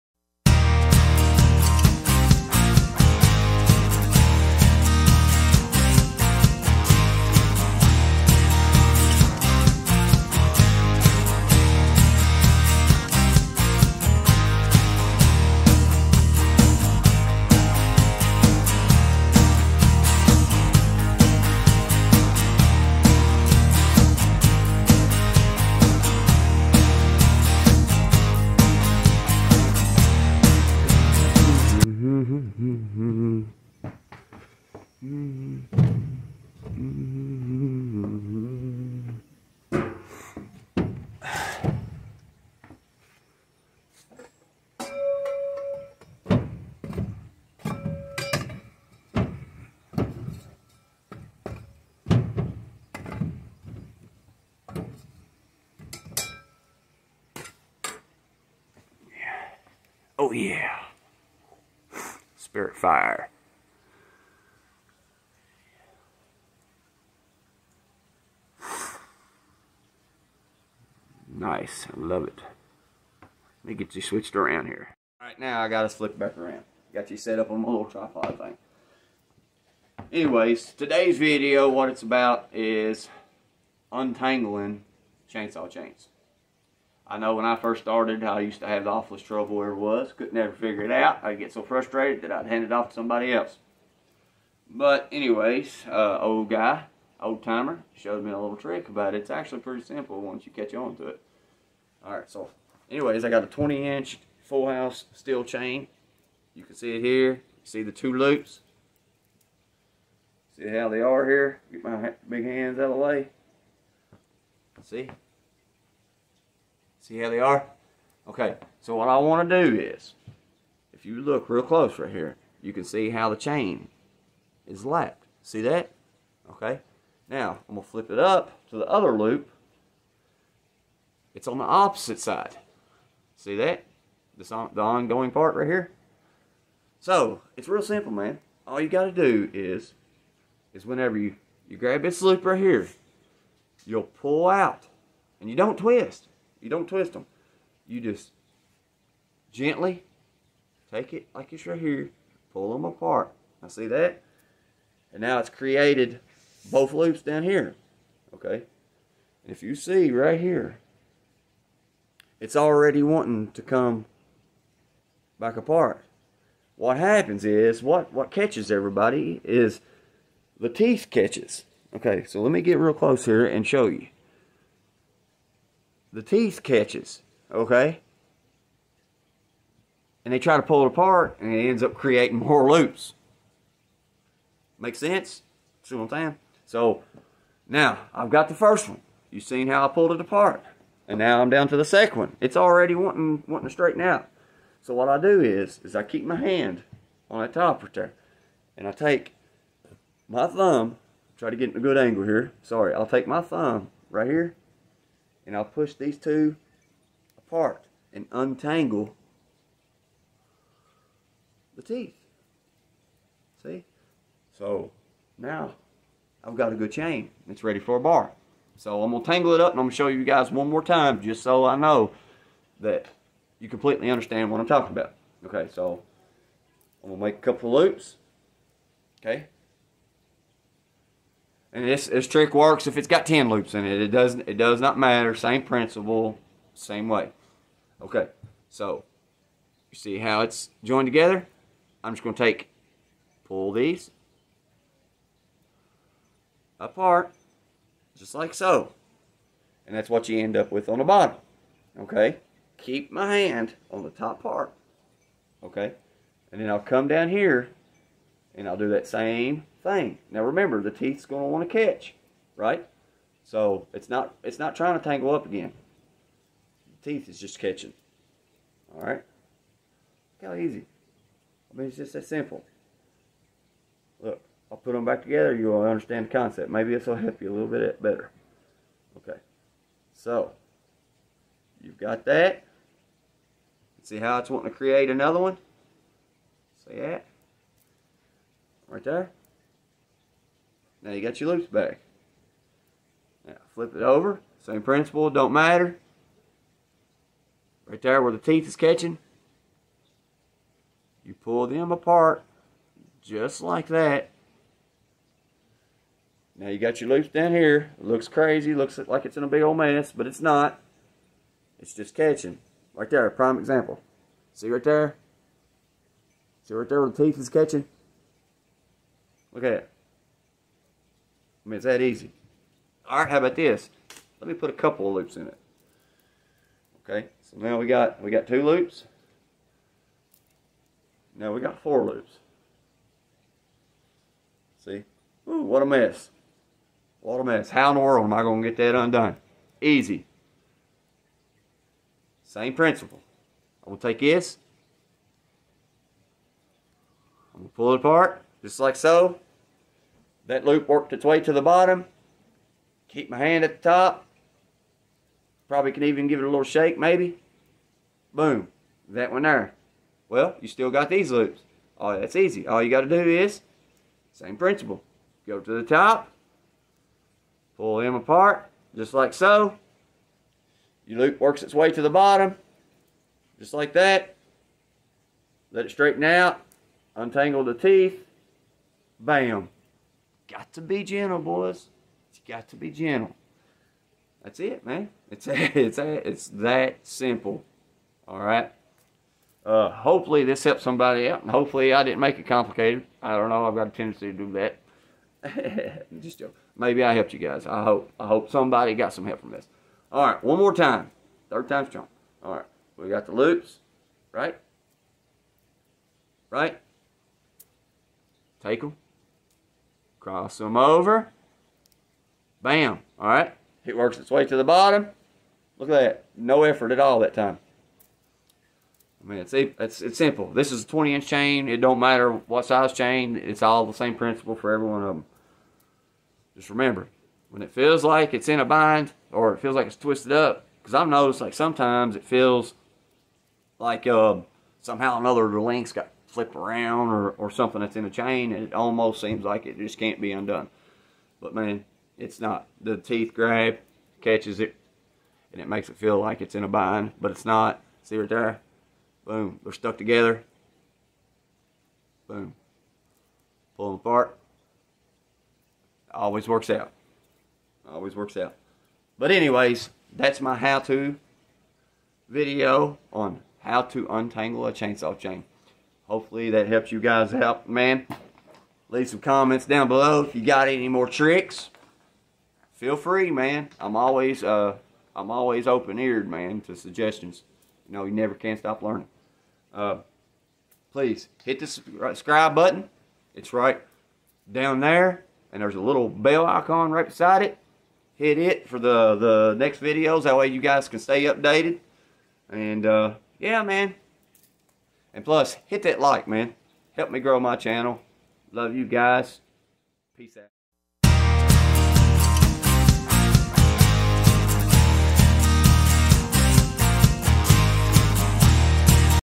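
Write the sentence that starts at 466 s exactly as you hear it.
Hopefully that helps you guys out, man.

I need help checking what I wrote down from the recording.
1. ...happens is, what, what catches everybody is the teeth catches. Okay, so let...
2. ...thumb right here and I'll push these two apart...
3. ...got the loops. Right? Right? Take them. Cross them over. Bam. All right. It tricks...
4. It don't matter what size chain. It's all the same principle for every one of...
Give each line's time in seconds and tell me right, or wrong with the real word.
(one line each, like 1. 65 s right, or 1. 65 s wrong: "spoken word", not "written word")
1. 166 s right
2. 203 s right
3. 403 s wrong: "works", not "tricks"
4. 421 s right.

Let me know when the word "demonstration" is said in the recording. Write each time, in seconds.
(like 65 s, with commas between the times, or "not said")
not said.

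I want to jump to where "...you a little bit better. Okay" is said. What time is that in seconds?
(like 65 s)
277 s.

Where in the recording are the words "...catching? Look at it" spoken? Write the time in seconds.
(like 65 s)
317 s.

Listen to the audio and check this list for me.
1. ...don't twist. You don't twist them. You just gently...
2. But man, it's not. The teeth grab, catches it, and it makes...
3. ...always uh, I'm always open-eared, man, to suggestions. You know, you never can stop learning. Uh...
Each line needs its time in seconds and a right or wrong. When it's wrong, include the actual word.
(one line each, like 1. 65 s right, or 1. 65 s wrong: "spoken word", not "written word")
1. 145 s right
2. 441 s right
3. 473 s right.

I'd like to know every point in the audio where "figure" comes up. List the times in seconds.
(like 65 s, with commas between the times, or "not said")
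90 s.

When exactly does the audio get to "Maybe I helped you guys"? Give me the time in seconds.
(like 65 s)
396 s.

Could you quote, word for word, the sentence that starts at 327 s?
Okay, so now we got we got two loops.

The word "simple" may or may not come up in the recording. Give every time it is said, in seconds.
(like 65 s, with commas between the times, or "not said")
99 s, 137 s, 272 s, 387 s, 420 s.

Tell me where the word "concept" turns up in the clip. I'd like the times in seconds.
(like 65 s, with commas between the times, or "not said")
276 s.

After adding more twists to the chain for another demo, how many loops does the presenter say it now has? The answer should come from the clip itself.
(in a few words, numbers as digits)
4.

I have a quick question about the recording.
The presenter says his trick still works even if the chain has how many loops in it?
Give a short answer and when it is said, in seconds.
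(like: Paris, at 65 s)
10, at 233 s.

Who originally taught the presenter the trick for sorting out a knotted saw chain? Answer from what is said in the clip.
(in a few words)
old timer.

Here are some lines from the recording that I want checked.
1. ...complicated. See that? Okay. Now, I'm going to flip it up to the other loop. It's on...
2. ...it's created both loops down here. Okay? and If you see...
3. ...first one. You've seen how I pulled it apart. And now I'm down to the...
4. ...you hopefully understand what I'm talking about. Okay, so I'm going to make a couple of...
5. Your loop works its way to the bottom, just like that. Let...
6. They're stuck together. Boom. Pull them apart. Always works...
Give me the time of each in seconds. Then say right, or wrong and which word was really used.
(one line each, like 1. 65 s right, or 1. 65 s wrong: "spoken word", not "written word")
1. 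124 s wrong: "lapped", not "complicated"
2. 155 s right
3. 188 s right
4. 223 s wrong: "completely", not "hopefully"
5. 371 s right
6. 449 s right.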